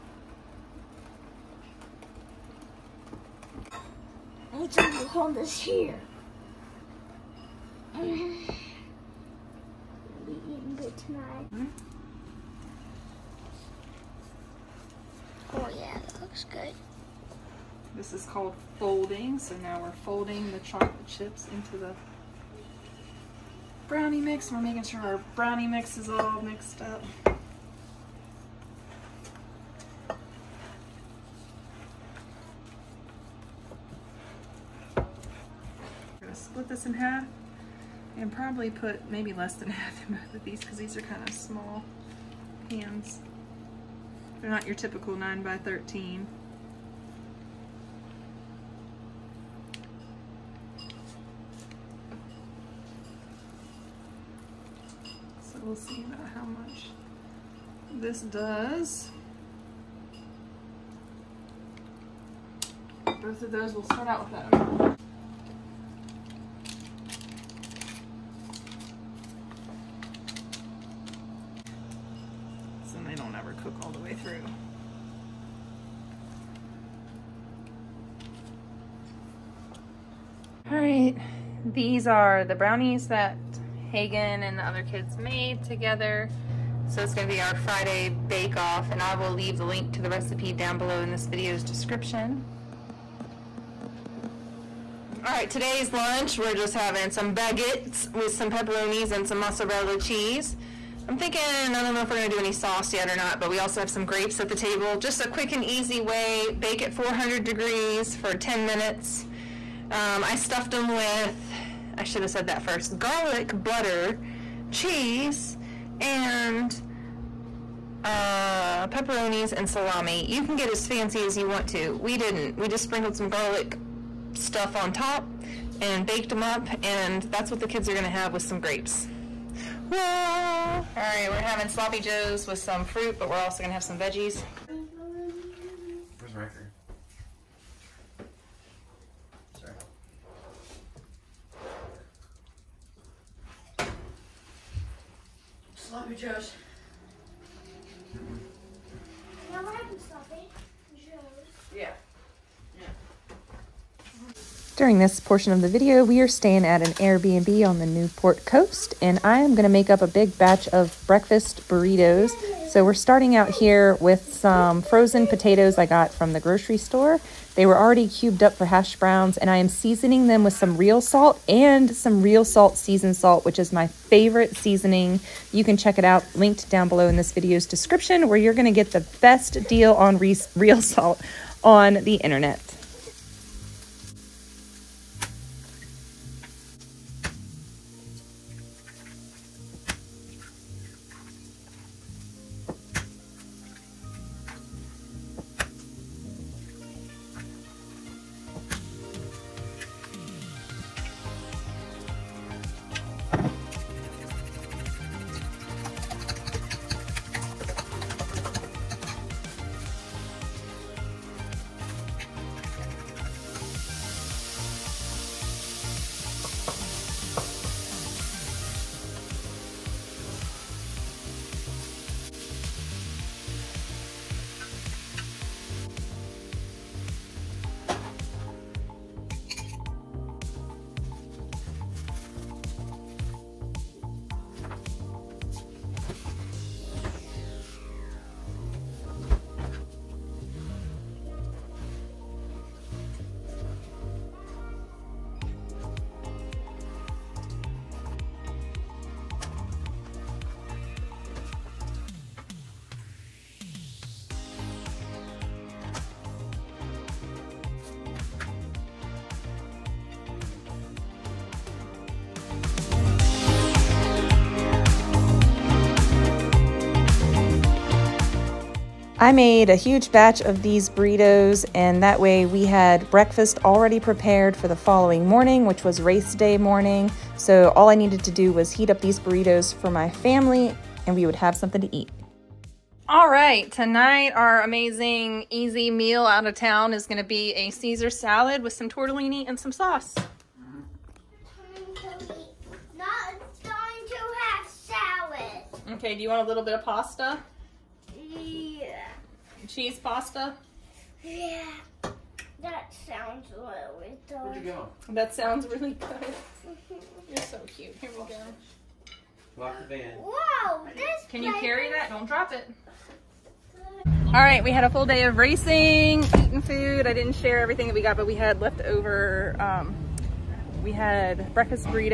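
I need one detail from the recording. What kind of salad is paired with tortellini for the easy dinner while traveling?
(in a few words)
Caesar salad.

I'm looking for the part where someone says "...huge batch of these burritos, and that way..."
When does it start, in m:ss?
4:29.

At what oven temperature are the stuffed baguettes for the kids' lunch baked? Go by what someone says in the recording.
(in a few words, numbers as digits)
400 degrees.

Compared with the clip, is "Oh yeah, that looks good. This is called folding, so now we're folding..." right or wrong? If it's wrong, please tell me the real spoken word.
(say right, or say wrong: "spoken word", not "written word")
right.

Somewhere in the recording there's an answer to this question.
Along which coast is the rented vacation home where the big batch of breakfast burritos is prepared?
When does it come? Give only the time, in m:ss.
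2:37.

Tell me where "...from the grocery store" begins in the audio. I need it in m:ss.
2:46.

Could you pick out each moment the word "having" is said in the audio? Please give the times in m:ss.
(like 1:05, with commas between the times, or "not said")
1:36, 2:11.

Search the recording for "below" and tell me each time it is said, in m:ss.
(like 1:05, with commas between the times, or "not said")
1:30, 2:56.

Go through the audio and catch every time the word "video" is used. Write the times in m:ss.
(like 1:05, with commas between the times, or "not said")
1:31, 2:35, 2:57.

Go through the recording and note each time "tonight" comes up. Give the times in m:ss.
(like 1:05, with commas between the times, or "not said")
0:10, 4:43.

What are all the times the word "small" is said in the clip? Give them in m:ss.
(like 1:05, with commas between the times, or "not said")
0:41.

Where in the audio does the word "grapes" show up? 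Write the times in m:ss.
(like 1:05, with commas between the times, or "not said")
1:44, 2:08.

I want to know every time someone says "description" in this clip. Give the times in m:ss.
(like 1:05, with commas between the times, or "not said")
1:31, 2:57.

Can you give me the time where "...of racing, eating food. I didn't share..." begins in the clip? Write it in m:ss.
5:15.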